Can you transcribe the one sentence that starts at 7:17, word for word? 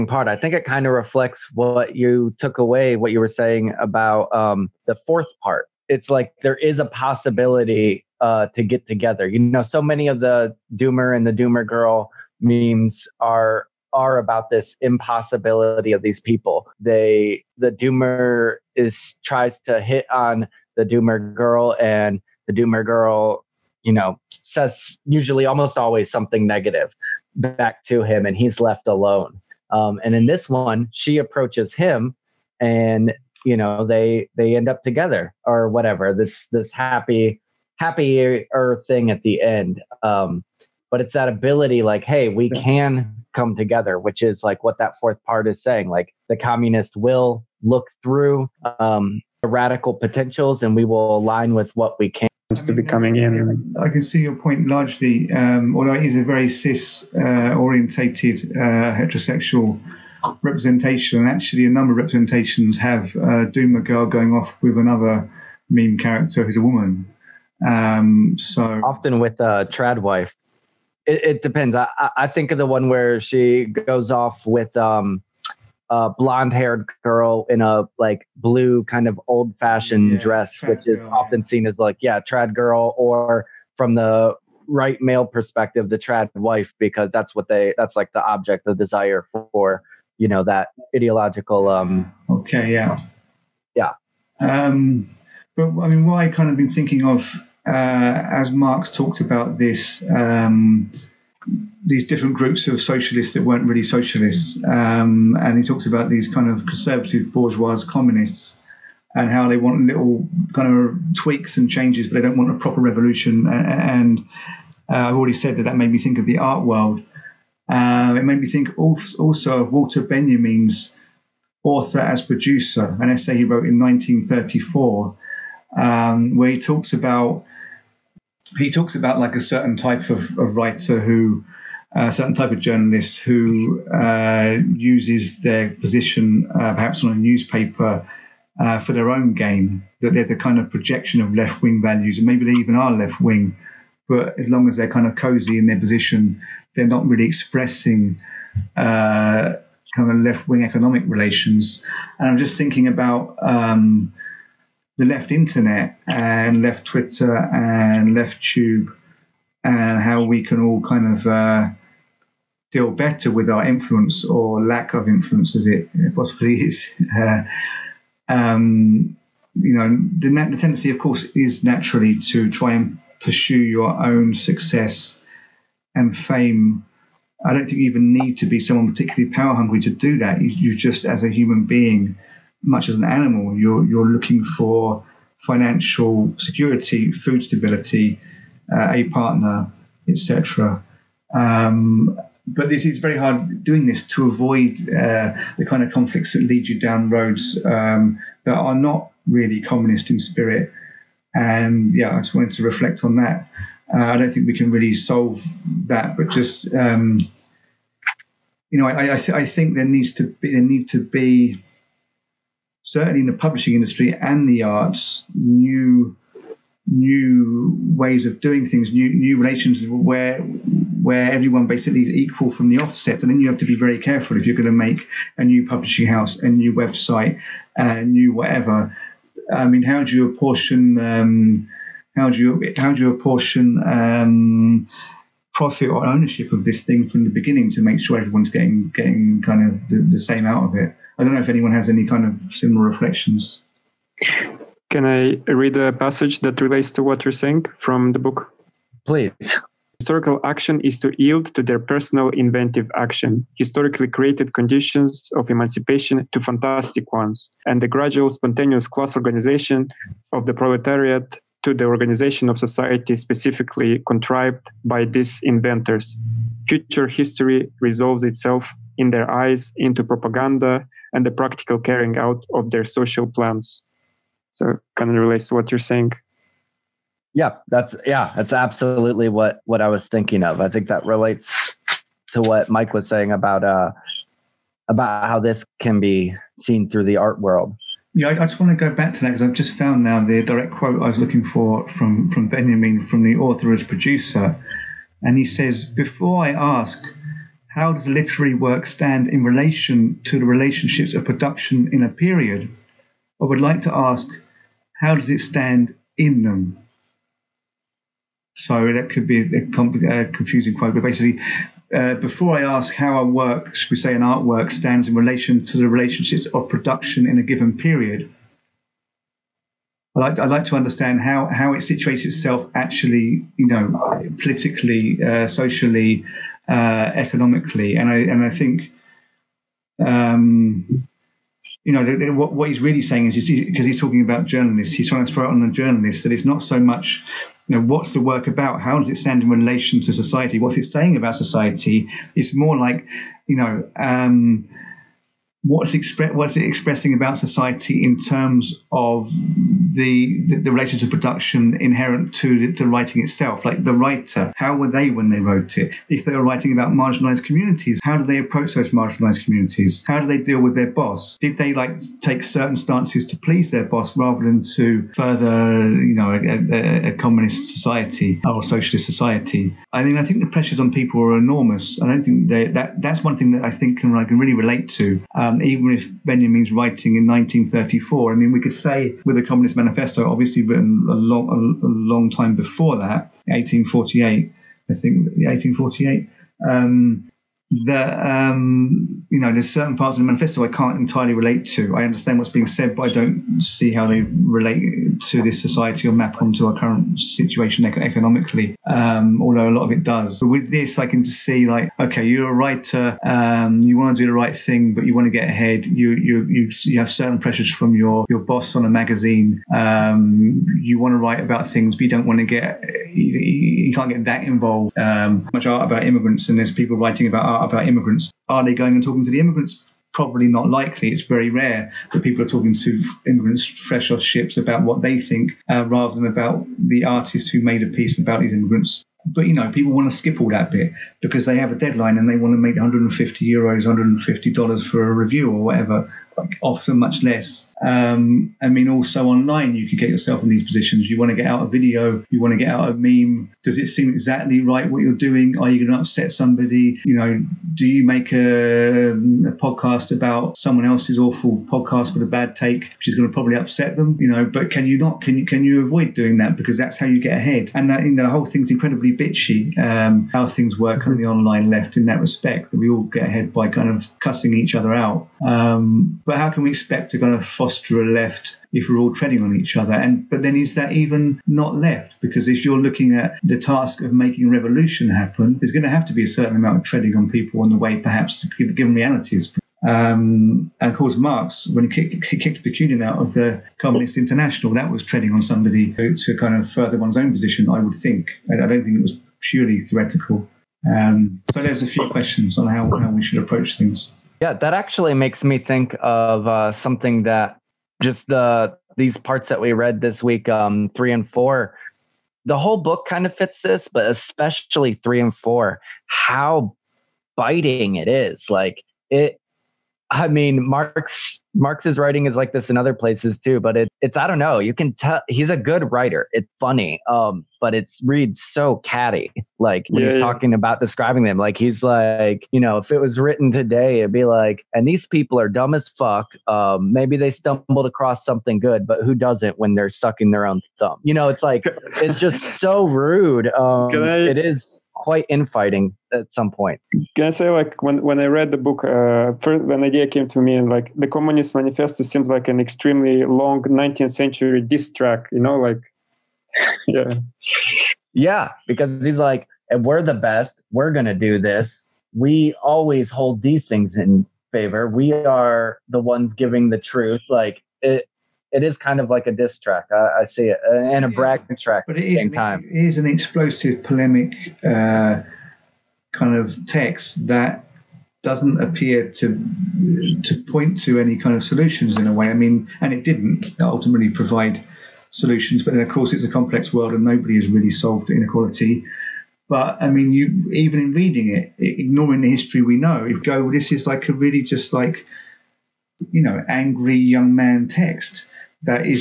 Um, I mean, also online, you can get yourself in these positions.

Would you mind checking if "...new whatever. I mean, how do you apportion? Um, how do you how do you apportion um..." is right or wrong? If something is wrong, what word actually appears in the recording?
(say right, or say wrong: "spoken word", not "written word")
right.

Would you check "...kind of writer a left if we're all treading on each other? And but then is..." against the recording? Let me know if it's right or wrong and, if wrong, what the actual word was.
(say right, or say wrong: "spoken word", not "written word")
wrong: "foster", not "writer".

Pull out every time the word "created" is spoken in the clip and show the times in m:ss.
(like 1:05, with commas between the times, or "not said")
4:14.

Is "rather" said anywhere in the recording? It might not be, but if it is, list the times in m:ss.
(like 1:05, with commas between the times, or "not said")
6:04, 7:05.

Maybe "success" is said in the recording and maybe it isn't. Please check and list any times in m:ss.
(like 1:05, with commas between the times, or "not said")
2:54.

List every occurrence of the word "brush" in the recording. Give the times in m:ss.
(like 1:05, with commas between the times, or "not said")
not said.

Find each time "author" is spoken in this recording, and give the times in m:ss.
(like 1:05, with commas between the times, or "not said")
2:01, 4:53.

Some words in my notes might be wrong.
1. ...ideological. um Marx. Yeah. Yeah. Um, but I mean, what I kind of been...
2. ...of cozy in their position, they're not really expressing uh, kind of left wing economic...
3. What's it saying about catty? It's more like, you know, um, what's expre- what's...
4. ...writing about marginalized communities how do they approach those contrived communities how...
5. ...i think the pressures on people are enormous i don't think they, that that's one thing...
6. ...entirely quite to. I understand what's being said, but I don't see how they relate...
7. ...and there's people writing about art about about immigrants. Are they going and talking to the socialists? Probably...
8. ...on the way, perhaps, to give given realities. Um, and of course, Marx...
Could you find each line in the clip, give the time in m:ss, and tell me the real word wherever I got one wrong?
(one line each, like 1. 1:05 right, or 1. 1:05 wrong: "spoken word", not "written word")
1. 1:30 wrong: "Okay", not "Marx"
2. 2:25 right
3. 5:40 wrong: "society", not "catty"
4. 5:56 wrong: "marginalized", not "contrived"
5. 6:10 right
6. 6:30 wrong: "relate", not "quite"
7. 6:56 wrong: "immigrants", not "socialists"
8. 7:57 right.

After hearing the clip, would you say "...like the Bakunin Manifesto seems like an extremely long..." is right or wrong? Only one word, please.
wrong.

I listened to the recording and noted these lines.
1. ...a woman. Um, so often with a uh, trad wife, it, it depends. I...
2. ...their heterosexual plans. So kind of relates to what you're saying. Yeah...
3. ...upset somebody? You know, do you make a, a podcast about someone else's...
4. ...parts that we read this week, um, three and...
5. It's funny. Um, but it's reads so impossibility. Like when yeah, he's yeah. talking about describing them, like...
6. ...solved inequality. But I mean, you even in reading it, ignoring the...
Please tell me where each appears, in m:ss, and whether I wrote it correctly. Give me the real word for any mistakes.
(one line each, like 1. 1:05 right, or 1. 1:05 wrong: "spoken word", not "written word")
1. 1:06 right
2. 4:32 wrong: "social", not "heterosexual"
3. 7:25 right
4. 8:19 right
5. 8:36 wrong: "catty", not "impossibility"
6. 9:37 right.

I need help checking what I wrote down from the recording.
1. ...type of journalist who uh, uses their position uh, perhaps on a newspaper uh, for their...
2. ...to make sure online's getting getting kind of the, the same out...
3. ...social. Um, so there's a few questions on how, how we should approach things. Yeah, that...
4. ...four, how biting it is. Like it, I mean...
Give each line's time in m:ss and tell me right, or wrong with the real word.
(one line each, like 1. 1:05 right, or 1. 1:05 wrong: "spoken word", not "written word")
1. 2:12 right
2. 3:57 wrong: "everyone", not "online"
3. 8:09 wrong: "theoretical", not "social"
4. 8:25 right.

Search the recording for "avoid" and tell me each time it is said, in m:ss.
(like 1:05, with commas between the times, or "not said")
3:14, 7:35.